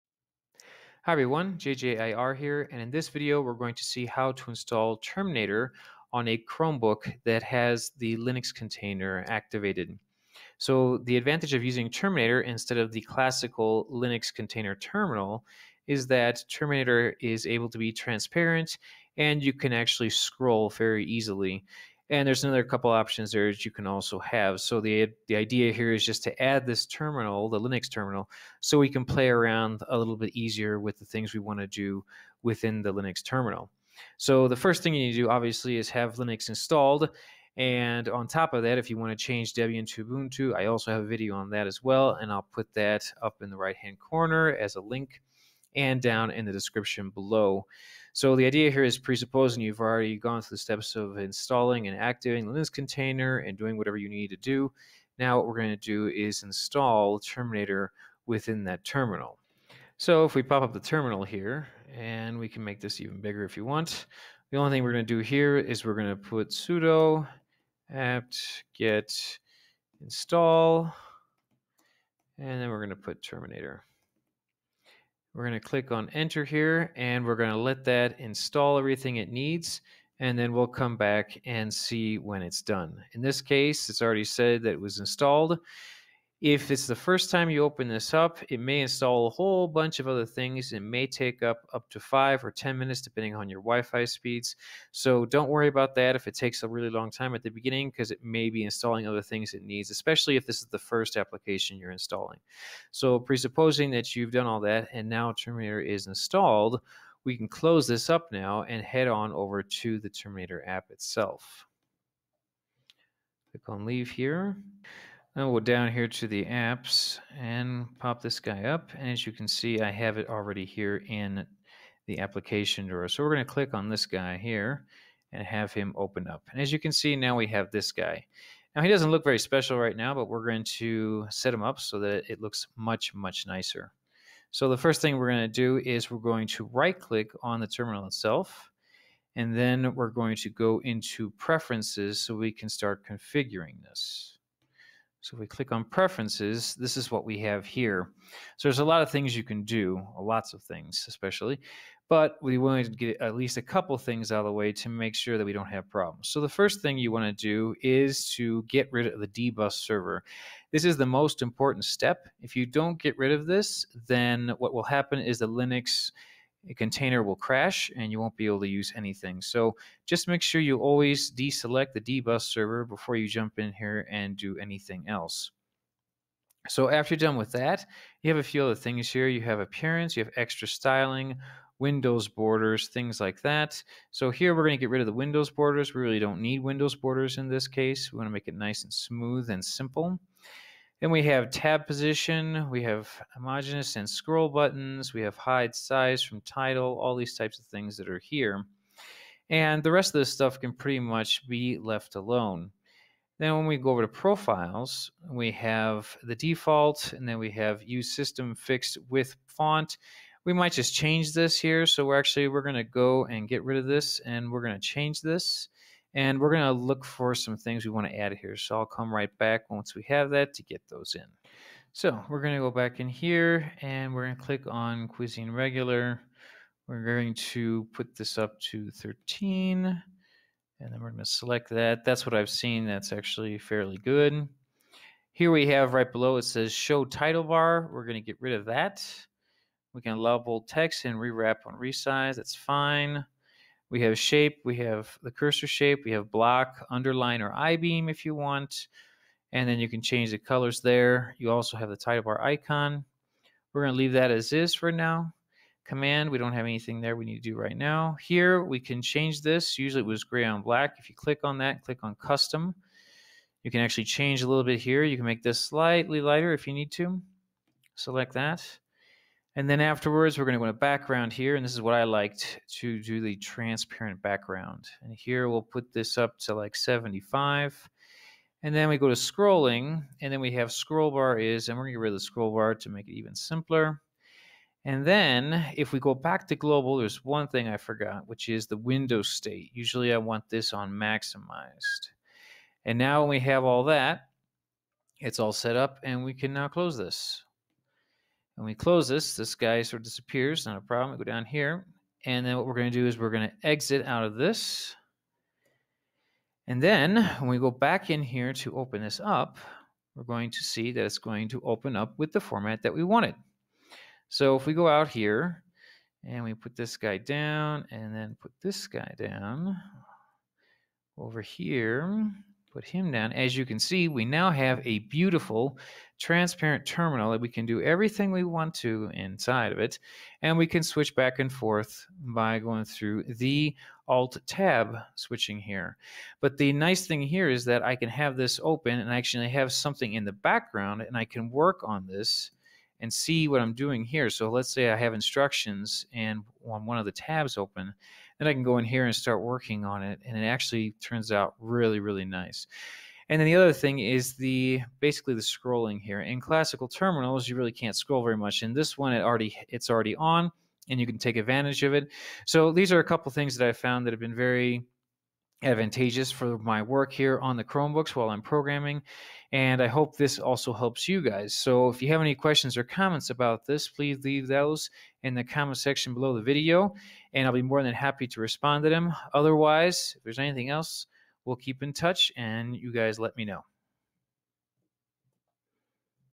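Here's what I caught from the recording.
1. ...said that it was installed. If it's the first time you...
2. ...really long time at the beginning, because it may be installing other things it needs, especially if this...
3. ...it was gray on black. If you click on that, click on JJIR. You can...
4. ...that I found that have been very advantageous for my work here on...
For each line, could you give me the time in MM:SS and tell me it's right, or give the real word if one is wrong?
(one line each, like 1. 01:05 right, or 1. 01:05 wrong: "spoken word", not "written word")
1. 01:24 right
2. 01:36 right
3. 04:19 wrong: "Custom", not "JJIR"
4. 06:03 right.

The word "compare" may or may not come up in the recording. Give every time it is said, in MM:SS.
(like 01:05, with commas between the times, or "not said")
not said.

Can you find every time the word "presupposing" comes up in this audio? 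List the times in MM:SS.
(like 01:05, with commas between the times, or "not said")
00:48, 01:43.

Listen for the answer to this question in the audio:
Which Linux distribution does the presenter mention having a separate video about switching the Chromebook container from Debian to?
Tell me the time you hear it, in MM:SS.
00:40.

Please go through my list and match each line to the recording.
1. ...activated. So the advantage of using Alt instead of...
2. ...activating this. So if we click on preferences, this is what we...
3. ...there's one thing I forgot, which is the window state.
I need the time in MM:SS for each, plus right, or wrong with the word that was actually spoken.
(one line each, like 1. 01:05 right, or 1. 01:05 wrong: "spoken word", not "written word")
1. 00:09 wrong: "Terminator", not "Alt"
2. 02:23 wrong: "configuring", not "activating"
3. 04:46 right.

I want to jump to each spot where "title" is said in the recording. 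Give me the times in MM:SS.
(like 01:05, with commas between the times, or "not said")
03:16, 03:57, 04:11.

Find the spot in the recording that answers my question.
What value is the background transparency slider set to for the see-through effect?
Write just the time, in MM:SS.
04:36.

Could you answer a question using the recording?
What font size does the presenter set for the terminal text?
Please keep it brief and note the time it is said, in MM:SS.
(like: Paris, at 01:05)
13, at 03:48.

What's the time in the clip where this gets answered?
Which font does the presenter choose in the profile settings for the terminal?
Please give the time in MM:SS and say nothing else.
03:45.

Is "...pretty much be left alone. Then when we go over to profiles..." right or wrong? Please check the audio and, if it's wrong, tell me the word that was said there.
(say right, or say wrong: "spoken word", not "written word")
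right.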